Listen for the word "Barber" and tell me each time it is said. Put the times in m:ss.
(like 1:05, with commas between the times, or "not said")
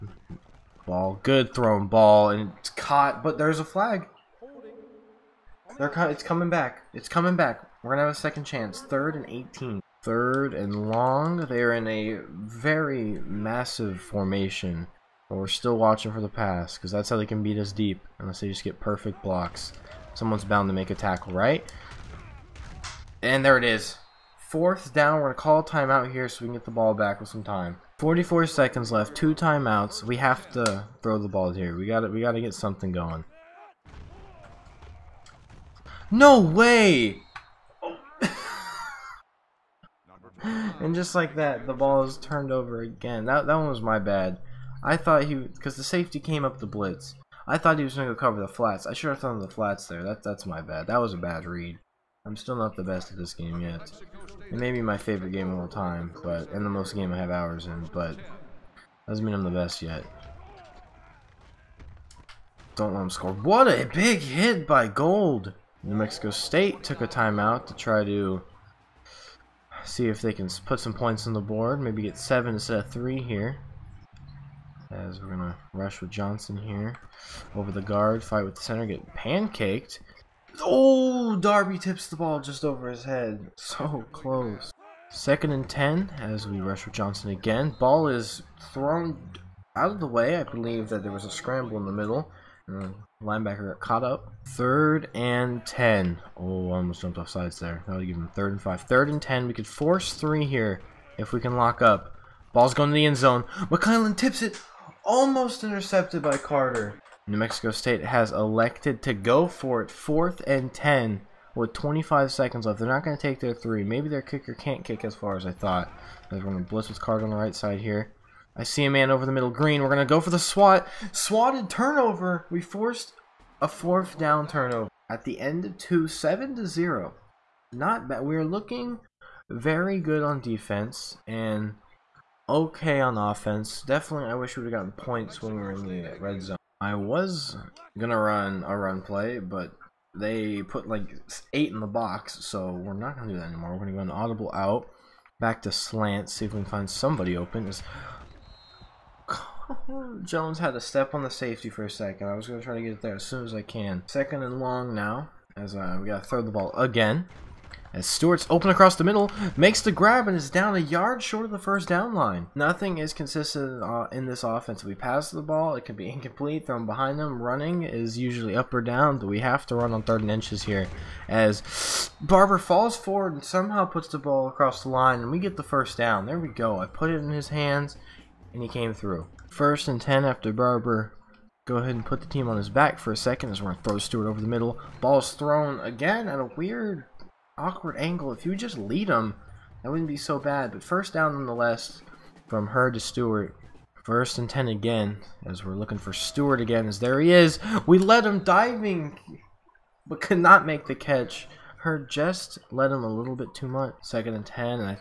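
2:52, 3:00.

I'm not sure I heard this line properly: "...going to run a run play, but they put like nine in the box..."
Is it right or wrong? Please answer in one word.
wrong.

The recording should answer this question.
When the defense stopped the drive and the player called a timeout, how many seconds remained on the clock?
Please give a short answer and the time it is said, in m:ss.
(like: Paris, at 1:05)
44, at 0:27.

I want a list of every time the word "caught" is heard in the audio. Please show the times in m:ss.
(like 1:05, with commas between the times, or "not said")
0:02, 1:33.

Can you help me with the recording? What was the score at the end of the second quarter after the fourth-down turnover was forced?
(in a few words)
7 to 0.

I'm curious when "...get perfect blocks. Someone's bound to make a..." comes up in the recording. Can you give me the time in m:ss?
0:18.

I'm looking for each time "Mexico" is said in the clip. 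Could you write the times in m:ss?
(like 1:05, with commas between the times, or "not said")
1:05, 1:47.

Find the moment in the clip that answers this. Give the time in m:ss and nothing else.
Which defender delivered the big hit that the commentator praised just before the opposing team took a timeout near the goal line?
1:04.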